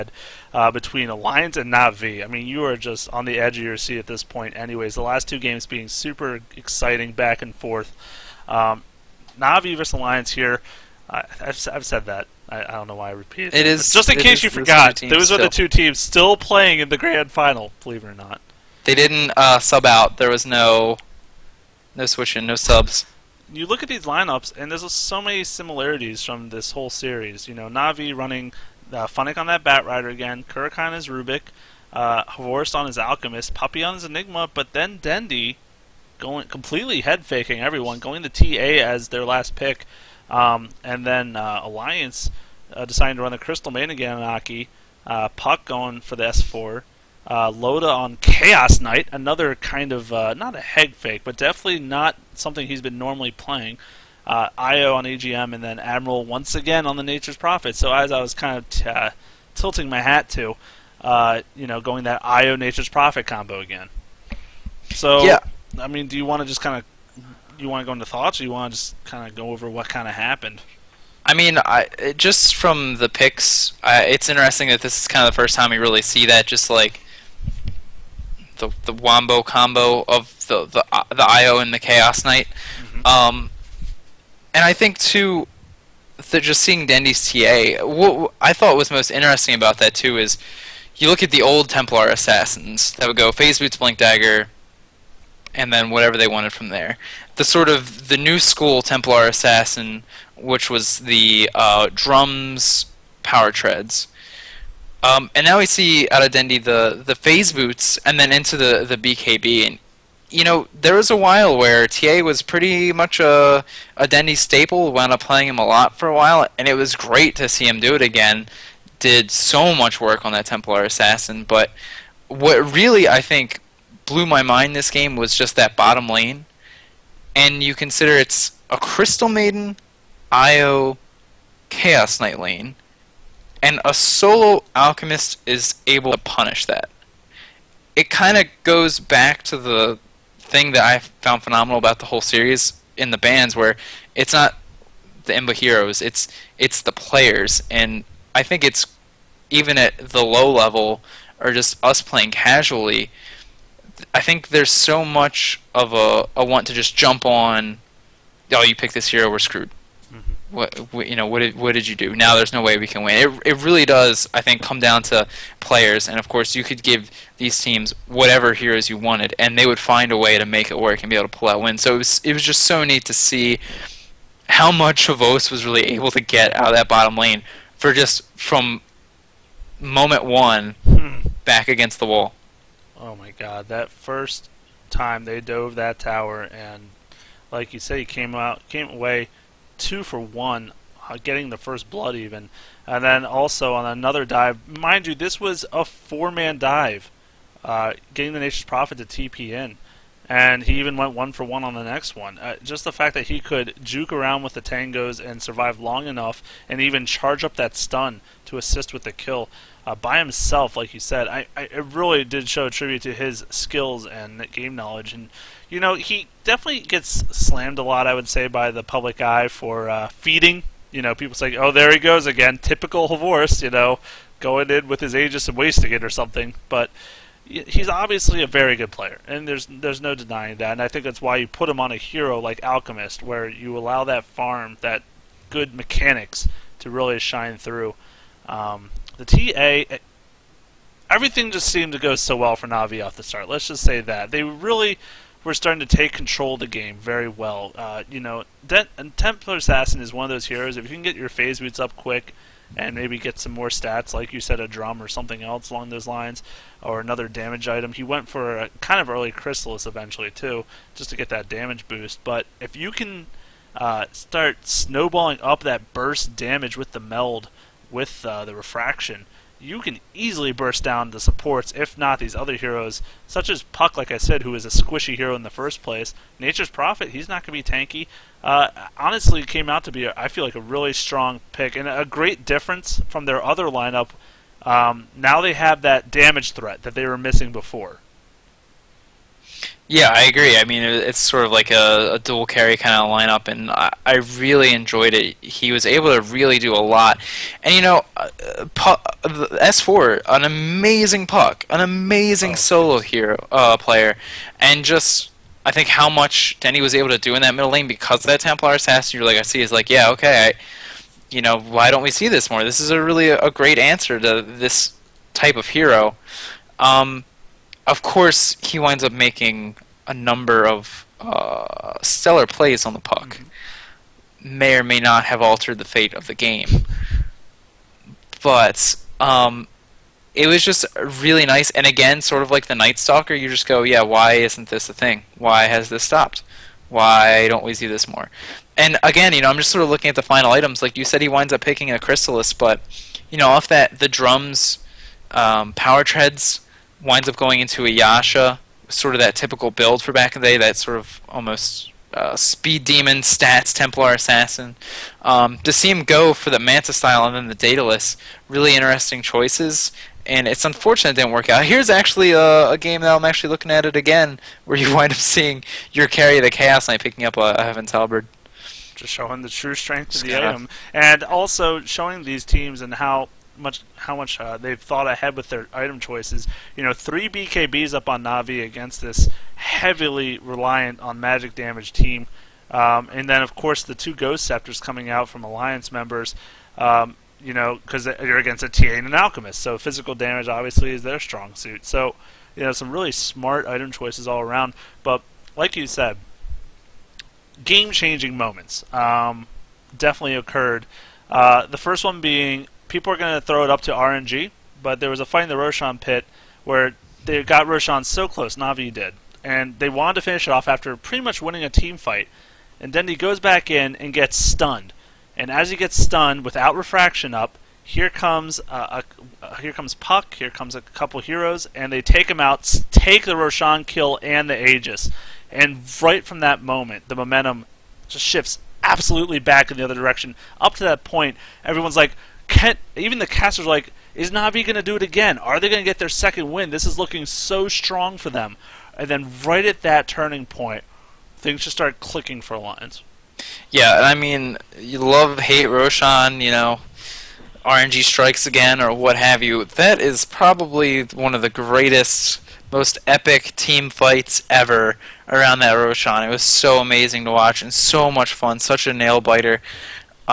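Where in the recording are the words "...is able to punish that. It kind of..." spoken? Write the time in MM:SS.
02:15.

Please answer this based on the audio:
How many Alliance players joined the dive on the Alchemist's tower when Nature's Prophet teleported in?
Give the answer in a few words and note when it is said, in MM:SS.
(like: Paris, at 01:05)
4, at 03:15.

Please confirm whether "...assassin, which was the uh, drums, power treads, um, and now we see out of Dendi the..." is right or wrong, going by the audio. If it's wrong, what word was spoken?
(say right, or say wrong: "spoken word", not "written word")
right.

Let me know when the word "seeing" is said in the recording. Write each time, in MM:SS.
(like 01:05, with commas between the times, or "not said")
01:26, 06:05.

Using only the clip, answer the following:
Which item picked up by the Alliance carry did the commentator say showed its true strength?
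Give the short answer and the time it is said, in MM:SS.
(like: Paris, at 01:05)
Heaven's Halberd, at 06:07.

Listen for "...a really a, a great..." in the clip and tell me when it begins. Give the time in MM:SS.
05:12.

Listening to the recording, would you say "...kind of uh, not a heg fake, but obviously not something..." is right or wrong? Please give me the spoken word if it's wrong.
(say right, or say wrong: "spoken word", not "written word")
wrong: "definitely", not "obviously".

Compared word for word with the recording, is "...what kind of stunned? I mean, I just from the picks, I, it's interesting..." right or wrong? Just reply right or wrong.
wrong.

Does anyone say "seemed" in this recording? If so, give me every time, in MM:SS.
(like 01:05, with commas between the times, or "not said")
04:01.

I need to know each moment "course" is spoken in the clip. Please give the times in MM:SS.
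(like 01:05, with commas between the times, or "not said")
02:46, 05:18, 06:23.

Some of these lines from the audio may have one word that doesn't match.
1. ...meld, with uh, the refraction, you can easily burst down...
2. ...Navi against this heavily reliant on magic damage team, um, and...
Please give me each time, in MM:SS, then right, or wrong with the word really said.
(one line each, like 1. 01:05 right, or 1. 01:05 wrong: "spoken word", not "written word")
1. 04:26 right
2. 06:18 right.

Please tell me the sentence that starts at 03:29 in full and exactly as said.
Uh, by himself, like you said.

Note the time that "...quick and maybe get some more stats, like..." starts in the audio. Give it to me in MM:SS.
04:11.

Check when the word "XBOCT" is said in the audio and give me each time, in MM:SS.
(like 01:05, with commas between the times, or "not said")
02:55, 03:43.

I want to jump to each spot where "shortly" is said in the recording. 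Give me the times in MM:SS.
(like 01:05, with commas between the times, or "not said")
not said.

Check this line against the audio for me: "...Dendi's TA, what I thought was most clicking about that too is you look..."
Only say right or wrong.
wrong.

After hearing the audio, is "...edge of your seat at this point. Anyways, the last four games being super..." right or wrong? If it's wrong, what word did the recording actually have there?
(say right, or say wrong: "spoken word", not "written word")
wrong: "two", not "four".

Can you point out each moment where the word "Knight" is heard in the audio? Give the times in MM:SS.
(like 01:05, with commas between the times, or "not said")
00:48, 01:22, 02:12, 06:06.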